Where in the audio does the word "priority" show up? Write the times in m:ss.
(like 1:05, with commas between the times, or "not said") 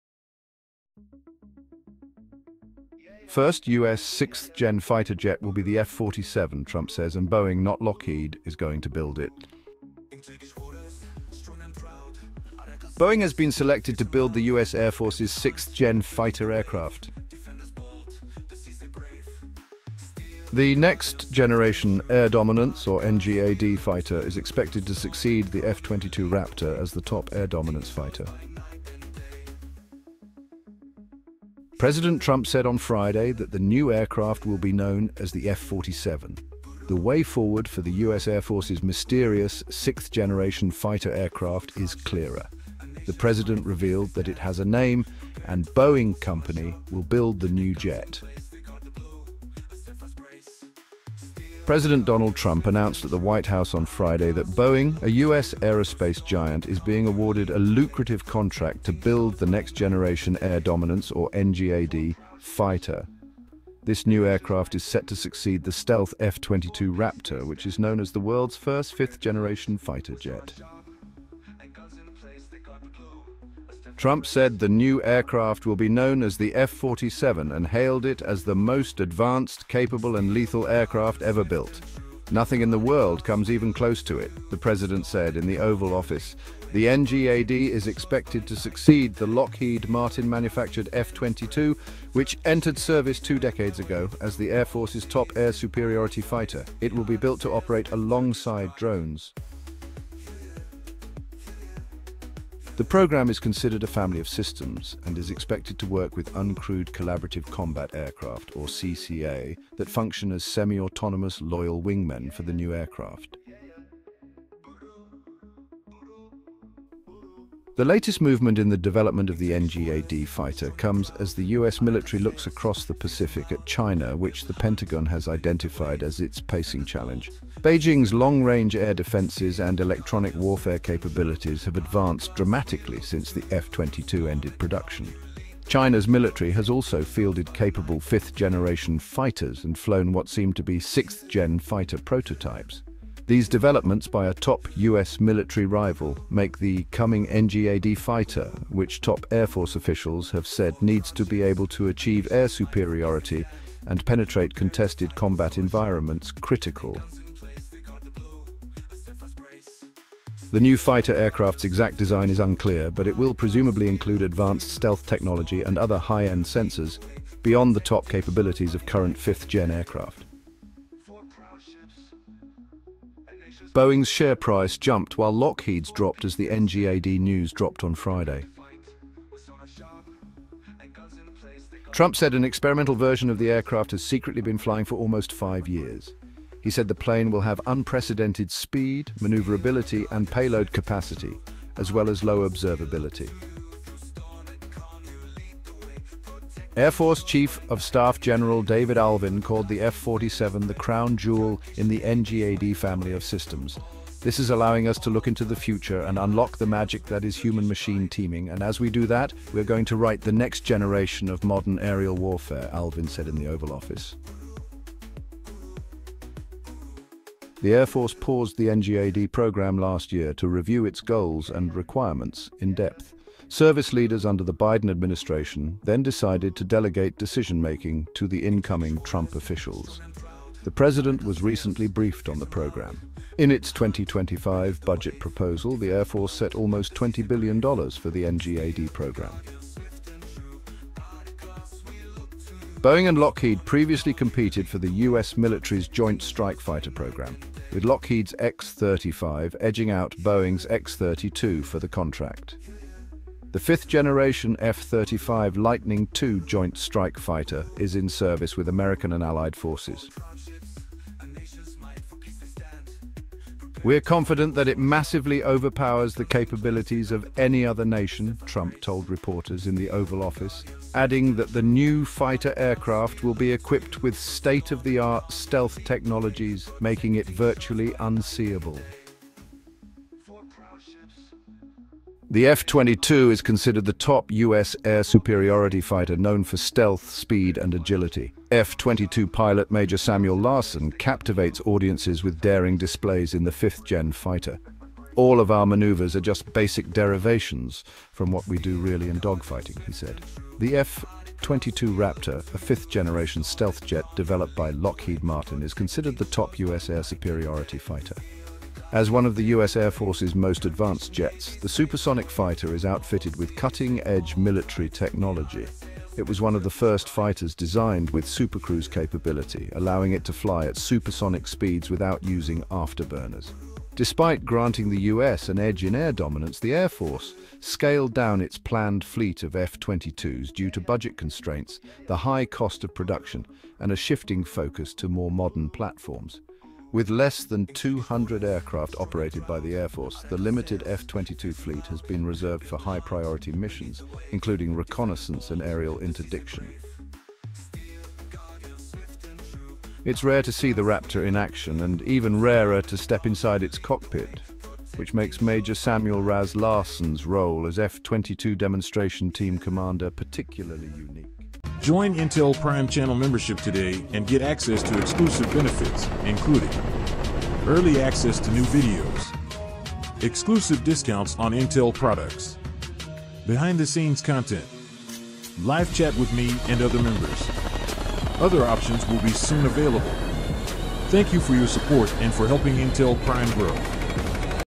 5:42.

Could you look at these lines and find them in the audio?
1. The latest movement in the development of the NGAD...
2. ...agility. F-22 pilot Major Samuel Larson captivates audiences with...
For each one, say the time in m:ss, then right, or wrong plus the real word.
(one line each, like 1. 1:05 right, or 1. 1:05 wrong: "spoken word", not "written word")
1. 1:57 right
2. 4:47 right.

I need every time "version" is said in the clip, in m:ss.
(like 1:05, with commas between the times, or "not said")
3:02.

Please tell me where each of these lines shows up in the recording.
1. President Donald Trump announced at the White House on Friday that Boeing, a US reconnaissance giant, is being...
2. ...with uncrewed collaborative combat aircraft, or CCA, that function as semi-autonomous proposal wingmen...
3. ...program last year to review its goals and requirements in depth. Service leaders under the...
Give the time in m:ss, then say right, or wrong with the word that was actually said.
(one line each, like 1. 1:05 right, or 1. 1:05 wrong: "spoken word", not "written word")
1. 0:51 wrong: "aerospace", not "reconnaissance"
2. 1:46 wrong: "loyal", not "proposal"
3. 3:39 right.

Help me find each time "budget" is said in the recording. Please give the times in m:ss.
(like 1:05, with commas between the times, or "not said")
3:54, 5:30.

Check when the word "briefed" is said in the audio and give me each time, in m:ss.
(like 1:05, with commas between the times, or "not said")
3:51.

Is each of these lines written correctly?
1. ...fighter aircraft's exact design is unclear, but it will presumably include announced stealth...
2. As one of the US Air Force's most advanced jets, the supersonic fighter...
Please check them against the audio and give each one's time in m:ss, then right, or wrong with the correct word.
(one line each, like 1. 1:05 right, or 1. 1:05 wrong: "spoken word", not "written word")
1. 2:40 wrong: "advanced", not "announced"
2. 5:08 right.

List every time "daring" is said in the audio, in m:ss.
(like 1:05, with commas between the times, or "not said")
4:52.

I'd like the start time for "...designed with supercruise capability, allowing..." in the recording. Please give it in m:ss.
5:17.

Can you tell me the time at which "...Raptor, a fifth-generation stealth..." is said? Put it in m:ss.
5:01.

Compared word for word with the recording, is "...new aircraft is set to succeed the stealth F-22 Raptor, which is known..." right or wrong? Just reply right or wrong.
right.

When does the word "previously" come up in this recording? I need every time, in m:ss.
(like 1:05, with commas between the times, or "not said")
4:03.